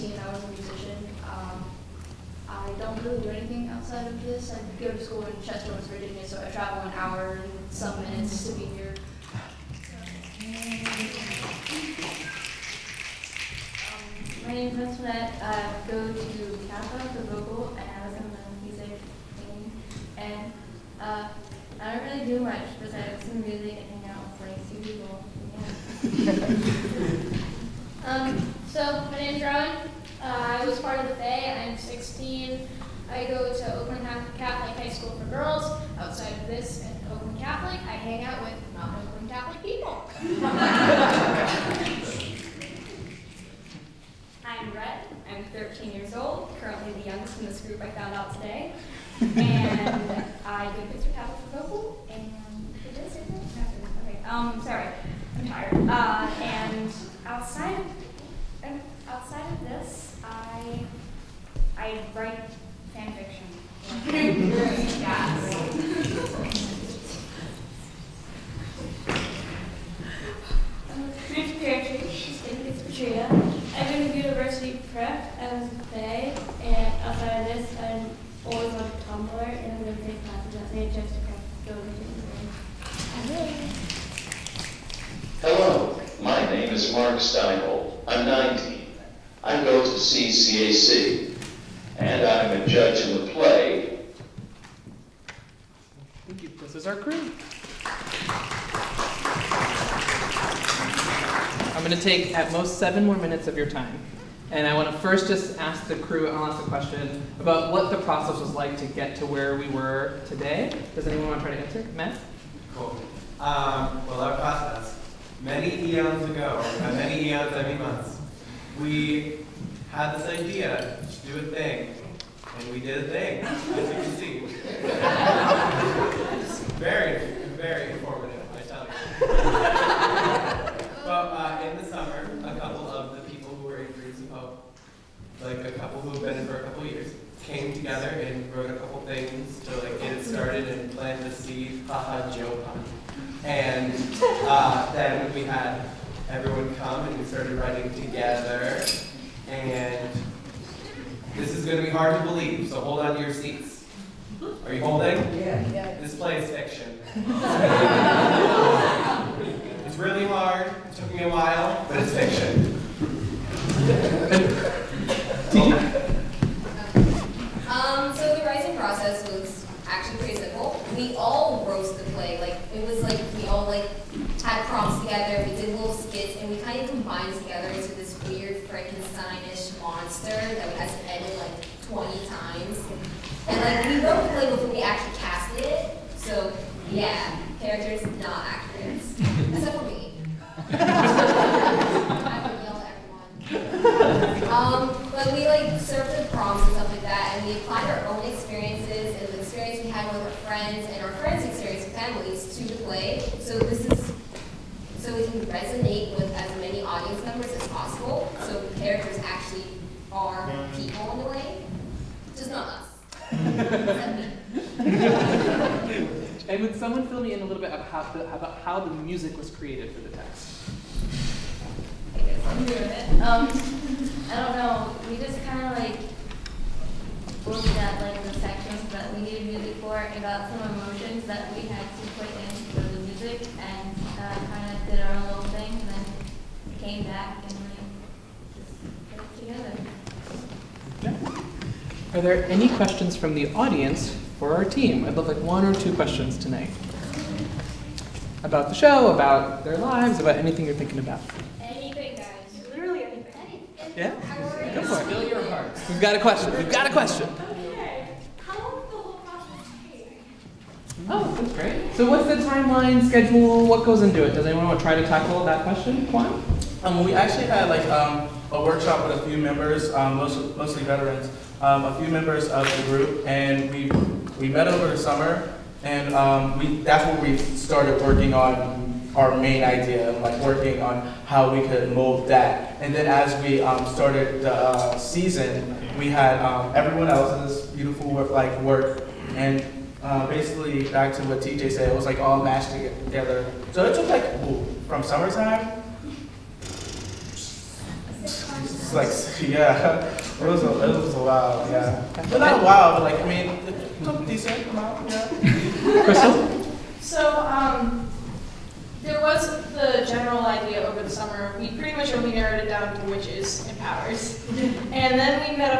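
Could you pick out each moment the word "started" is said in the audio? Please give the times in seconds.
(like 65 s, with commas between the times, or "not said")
140 s, 147 s, 277 s, 283 s.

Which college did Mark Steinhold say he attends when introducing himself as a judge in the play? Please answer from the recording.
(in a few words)
CCAC.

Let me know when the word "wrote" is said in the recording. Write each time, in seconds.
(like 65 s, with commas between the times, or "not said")
138 s, 184 s.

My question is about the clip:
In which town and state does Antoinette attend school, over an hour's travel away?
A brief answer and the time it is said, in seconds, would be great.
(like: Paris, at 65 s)
Chester, West Virginia, at 5 s.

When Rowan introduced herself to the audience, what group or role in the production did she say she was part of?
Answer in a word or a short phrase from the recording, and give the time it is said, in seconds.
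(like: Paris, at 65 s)
the Fae, at 31 s.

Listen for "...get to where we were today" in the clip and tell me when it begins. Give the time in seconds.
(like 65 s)
108 s.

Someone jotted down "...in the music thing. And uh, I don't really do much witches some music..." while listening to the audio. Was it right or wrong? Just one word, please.
wrong.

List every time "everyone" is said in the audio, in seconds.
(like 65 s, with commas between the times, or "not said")
146 s, 193 s, 286 s.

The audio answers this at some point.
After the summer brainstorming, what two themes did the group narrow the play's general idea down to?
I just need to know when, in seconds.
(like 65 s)
313 s.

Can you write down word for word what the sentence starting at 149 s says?
And this is going to be hard to believe, so hold on to your seats.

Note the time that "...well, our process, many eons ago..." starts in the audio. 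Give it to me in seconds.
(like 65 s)
114 s.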